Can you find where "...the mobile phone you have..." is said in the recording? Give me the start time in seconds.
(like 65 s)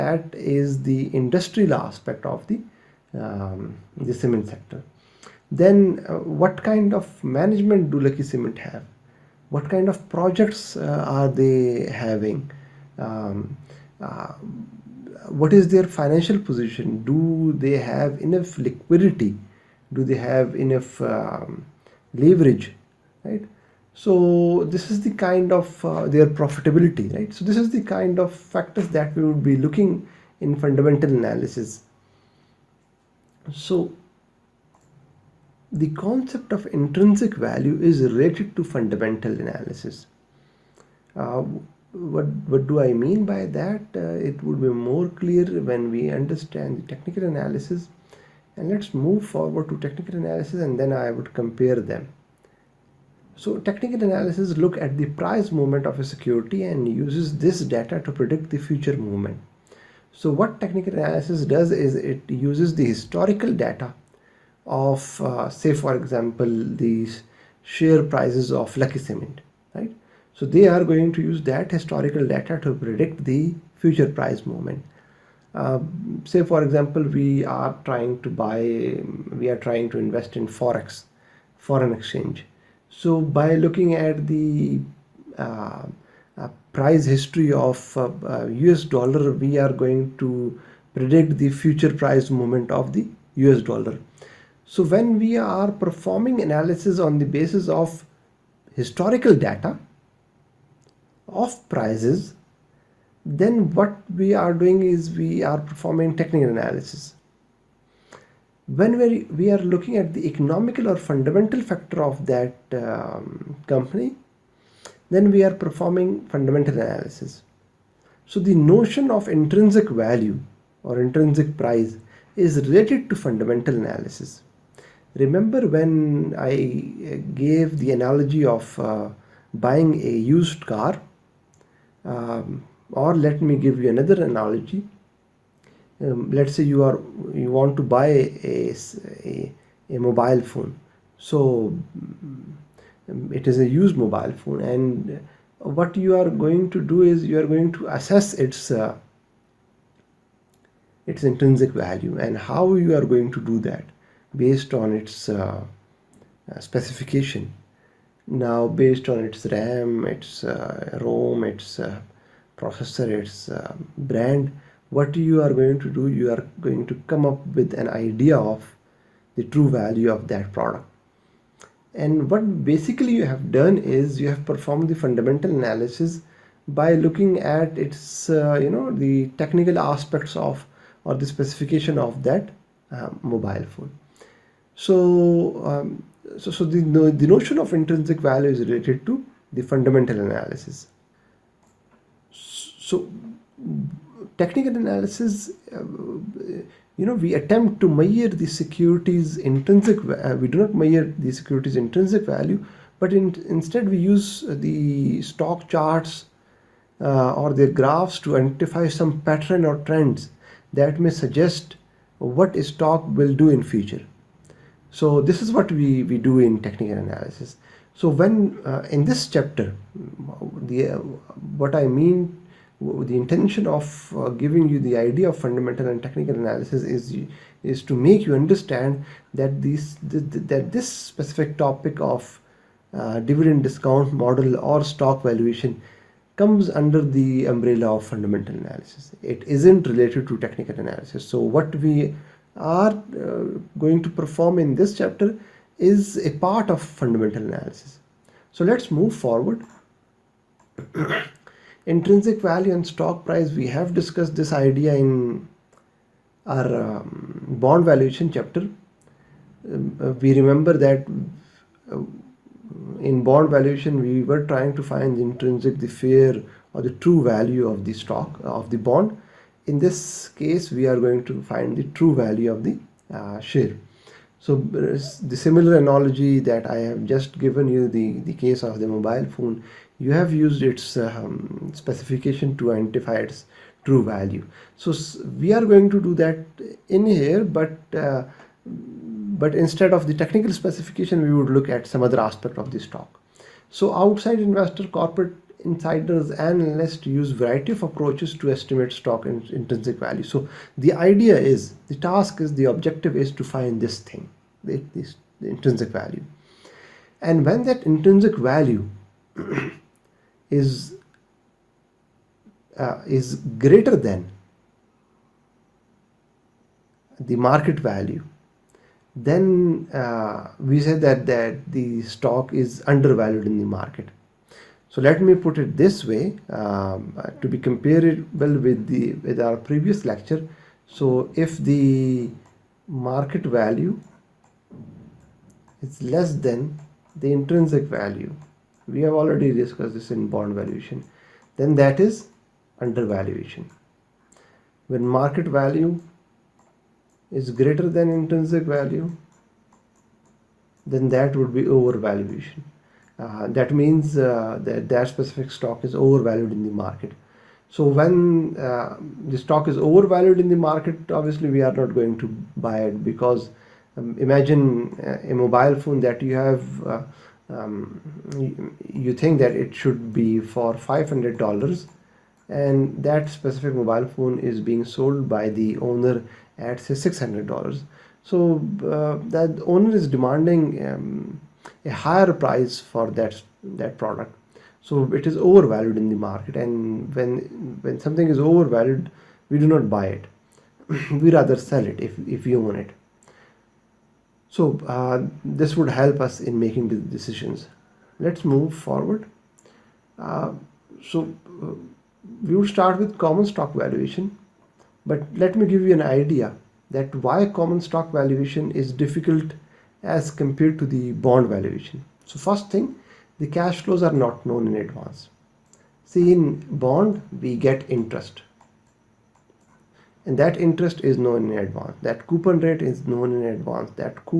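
278 s.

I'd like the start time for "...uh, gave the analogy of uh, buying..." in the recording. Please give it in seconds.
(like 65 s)
127 s.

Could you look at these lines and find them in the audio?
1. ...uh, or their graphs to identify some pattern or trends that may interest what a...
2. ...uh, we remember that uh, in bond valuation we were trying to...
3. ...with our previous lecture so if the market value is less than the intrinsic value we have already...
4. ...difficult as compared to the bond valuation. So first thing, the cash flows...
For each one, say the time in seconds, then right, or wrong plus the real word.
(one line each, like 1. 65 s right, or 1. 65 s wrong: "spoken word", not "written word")
1. 206 s wrong: "suggest", not "interest"
2. 260 s right
3. 329 s right
4. 408 s right.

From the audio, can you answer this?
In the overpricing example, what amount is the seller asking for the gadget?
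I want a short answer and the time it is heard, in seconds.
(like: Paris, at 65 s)
$600, at 376 s.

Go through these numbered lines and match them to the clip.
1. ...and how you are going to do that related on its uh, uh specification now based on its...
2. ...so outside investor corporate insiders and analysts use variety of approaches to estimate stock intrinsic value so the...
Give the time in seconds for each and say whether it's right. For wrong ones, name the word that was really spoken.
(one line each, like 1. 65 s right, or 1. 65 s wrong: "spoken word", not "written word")
1. 152 s wrong: "based", not "related"
2. 293 s right.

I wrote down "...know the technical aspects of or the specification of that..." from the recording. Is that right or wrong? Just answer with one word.
right.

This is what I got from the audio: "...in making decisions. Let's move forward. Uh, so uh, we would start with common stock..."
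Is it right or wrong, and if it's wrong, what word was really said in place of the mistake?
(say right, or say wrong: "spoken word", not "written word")
right.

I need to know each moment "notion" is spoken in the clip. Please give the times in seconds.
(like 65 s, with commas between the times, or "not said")
118 s, 187 s.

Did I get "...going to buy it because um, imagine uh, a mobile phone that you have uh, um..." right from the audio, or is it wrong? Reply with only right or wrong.
right.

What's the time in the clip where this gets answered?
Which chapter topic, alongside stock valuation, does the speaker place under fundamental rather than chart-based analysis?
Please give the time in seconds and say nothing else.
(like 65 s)
233 s.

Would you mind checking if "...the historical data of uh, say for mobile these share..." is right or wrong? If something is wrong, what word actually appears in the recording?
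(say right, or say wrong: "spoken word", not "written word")
wrong: "example", not "mobile".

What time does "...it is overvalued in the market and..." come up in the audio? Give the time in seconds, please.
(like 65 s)
385 s.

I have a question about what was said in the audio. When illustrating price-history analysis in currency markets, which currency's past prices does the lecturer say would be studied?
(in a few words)
US dollar.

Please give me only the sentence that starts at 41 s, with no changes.
Uh, what, what do I mean by that?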